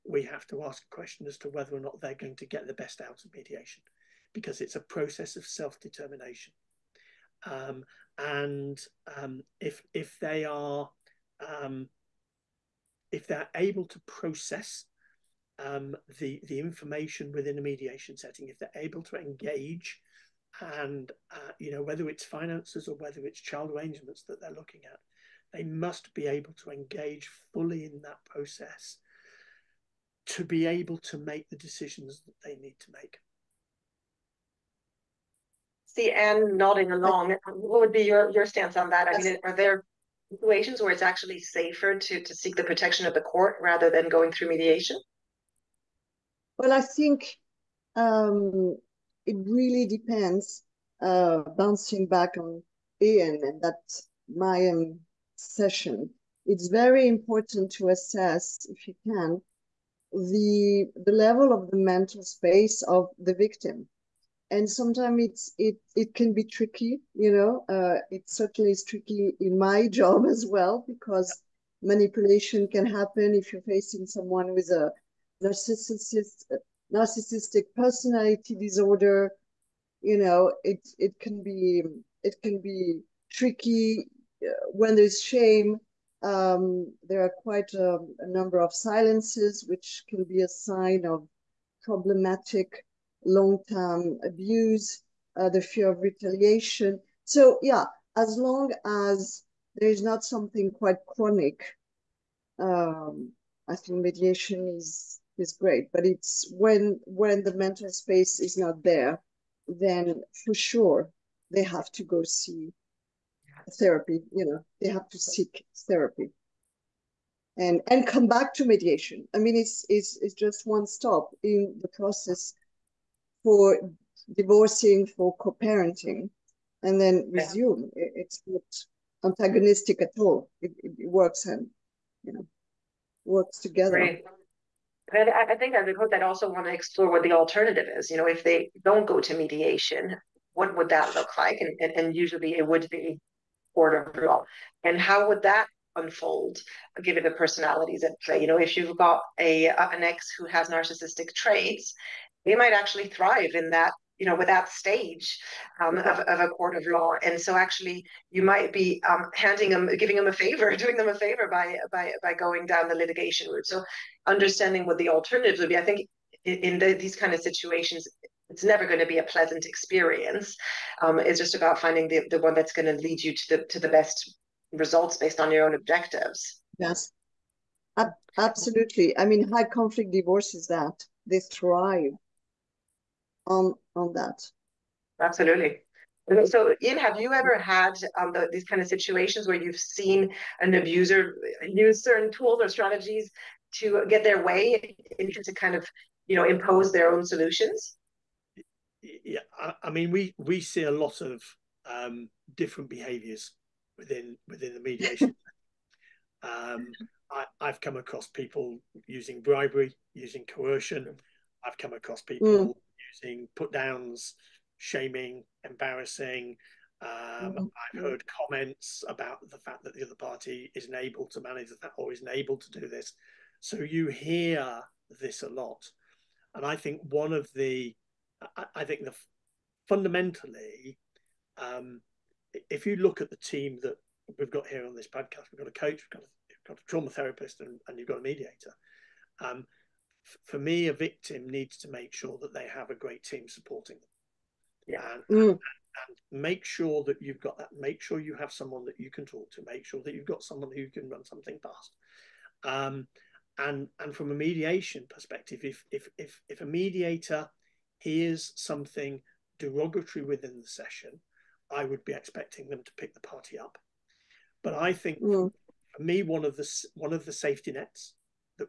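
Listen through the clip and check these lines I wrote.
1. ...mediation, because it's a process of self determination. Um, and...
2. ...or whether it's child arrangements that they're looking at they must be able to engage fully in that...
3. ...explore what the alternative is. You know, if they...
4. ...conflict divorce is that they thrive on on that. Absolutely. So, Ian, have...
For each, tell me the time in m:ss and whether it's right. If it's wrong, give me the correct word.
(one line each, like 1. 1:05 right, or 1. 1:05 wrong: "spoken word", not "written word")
1. 0:03 right
2. 0:22 right
3. 2:16 right
4. 2:59 right.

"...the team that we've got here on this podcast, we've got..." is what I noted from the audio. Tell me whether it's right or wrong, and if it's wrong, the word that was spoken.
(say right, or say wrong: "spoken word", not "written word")
right.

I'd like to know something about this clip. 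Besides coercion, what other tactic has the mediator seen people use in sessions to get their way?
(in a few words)
bribery.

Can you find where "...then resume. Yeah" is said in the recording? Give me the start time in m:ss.
2:07.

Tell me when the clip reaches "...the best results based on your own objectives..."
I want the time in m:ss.
2:53.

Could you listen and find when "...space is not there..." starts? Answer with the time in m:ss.
1:47.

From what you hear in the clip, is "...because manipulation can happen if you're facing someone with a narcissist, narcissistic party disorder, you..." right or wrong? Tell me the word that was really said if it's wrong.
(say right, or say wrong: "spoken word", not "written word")
wrong: "personality", not "party".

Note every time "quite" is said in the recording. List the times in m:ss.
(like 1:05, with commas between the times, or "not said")
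1:27, 1:40.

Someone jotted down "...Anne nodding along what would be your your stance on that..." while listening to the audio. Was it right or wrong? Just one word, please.
right.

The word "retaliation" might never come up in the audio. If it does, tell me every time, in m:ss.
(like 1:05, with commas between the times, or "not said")
1:36.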